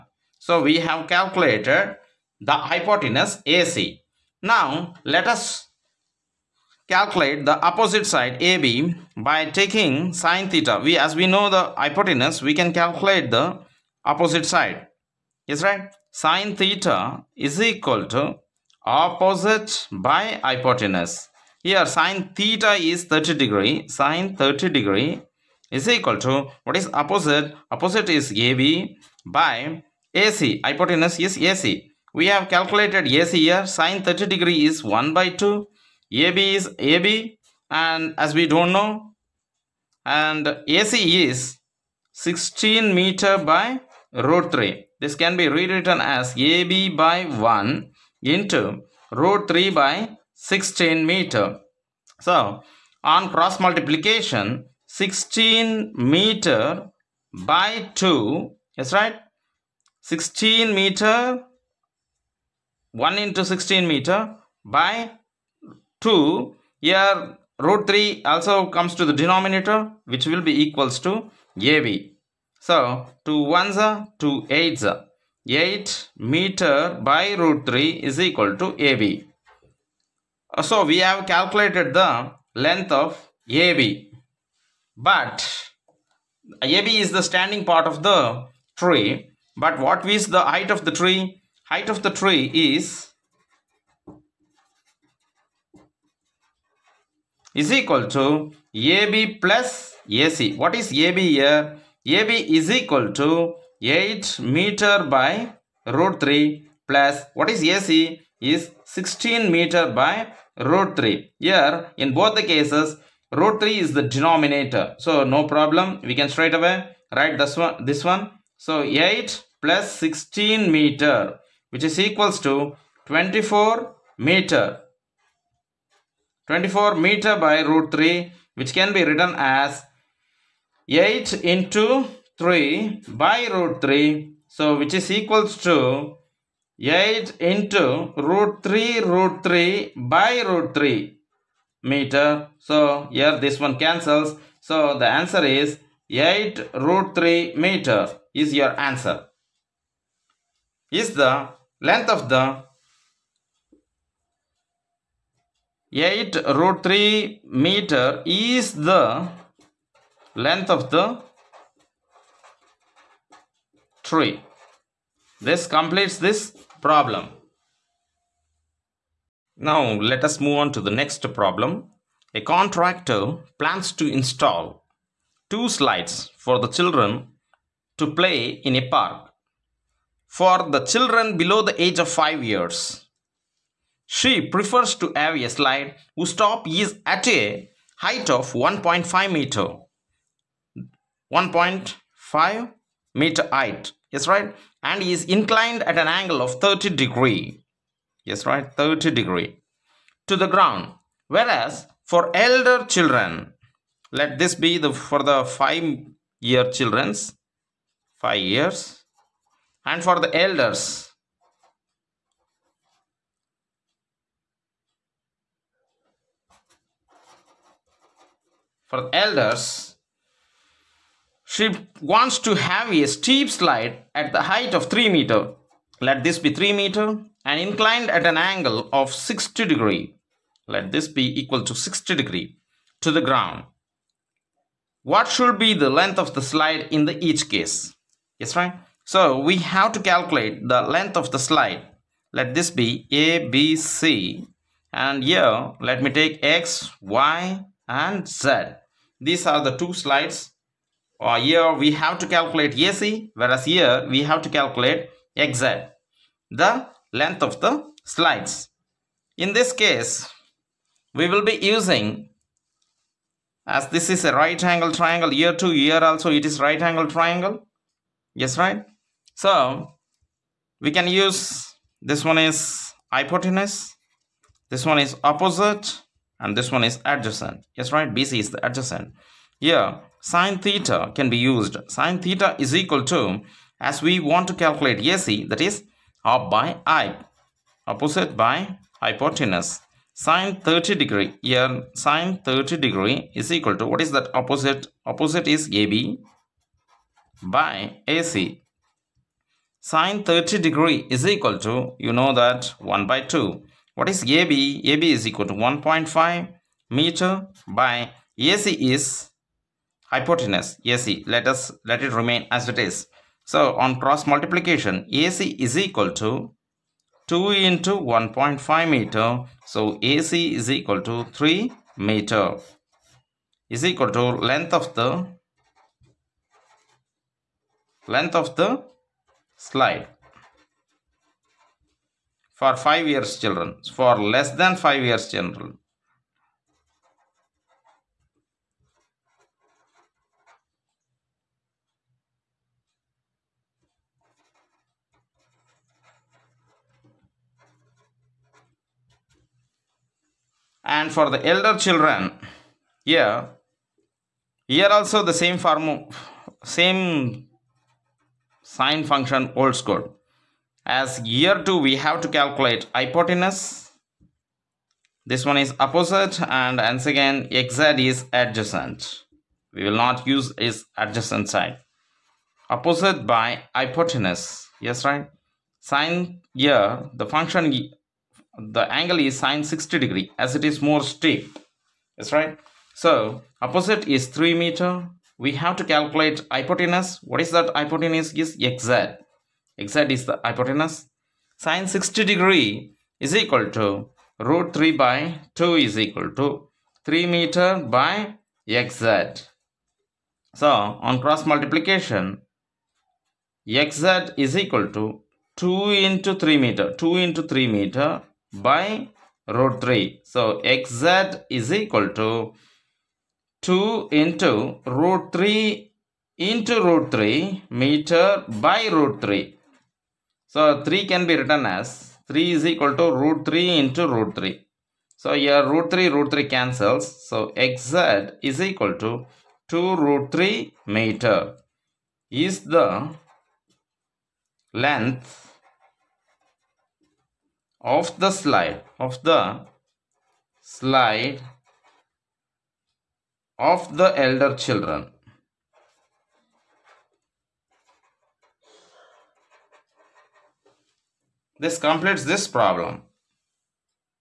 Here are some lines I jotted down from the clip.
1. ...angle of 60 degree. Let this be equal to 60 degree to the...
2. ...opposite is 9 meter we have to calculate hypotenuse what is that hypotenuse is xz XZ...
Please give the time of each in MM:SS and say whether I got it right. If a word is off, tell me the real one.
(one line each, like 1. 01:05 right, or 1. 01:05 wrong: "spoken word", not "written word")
1. 03:48 right
2. 06:23 wrong: "3", not "9".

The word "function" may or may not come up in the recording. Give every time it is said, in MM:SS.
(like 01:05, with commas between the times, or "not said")
05:59, 06:17.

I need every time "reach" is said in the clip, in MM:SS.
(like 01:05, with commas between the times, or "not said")
not said.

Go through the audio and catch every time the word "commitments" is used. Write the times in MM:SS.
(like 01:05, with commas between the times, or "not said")
not said.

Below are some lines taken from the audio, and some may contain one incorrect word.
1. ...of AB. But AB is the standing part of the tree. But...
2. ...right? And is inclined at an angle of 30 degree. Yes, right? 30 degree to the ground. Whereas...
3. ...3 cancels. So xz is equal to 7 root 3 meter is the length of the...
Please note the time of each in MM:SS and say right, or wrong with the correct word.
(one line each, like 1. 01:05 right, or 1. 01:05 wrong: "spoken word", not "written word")
1. 01:22 right
2. 03:14 right
3. 07:06 wrong: "2", not "7".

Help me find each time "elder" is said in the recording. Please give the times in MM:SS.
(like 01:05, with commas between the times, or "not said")
03:22, 03:30, 03:39, 05:51, 07:24.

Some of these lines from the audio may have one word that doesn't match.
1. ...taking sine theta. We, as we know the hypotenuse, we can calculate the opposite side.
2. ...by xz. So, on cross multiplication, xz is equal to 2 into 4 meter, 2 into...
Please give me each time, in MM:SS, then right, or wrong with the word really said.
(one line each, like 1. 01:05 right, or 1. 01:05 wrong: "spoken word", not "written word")
1. 00:09 right
2. 06:37 wrong: "3", not "4".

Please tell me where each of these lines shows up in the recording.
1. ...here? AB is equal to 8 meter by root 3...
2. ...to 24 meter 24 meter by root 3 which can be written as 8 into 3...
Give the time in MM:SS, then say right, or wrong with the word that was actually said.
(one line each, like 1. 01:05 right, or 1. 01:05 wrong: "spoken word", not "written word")
1. 01:41 right
2. 02:02 right.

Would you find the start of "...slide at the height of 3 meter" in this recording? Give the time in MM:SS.
03:43.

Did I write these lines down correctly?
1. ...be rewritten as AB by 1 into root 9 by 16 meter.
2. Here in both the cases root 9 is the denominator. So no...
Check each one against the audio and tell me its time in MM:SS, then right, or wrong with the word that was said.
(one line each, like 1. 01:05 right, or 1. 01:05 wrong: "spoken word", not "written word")
1. 00:45 wrong: "3", not "9"
2. 01:51 wrong: "3", not "9".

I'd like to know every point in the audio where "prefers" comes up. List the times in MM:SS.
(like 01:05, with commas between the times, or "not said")
03:04.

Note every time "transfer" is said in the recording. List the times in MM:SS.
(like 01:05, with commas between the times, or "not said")
not said.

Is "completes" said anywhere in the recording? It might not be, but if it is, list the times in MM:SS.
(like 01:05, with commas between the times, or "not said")
02:45, 07:31.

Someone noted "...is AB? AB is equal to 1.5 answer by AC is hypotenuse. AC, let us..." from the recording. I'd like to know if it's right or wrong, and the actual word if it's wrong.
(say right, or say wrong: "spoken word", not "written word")
wrong: "meter", not "answer".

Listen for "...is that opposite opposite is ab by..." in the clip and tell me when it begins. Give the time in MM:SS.
04:54.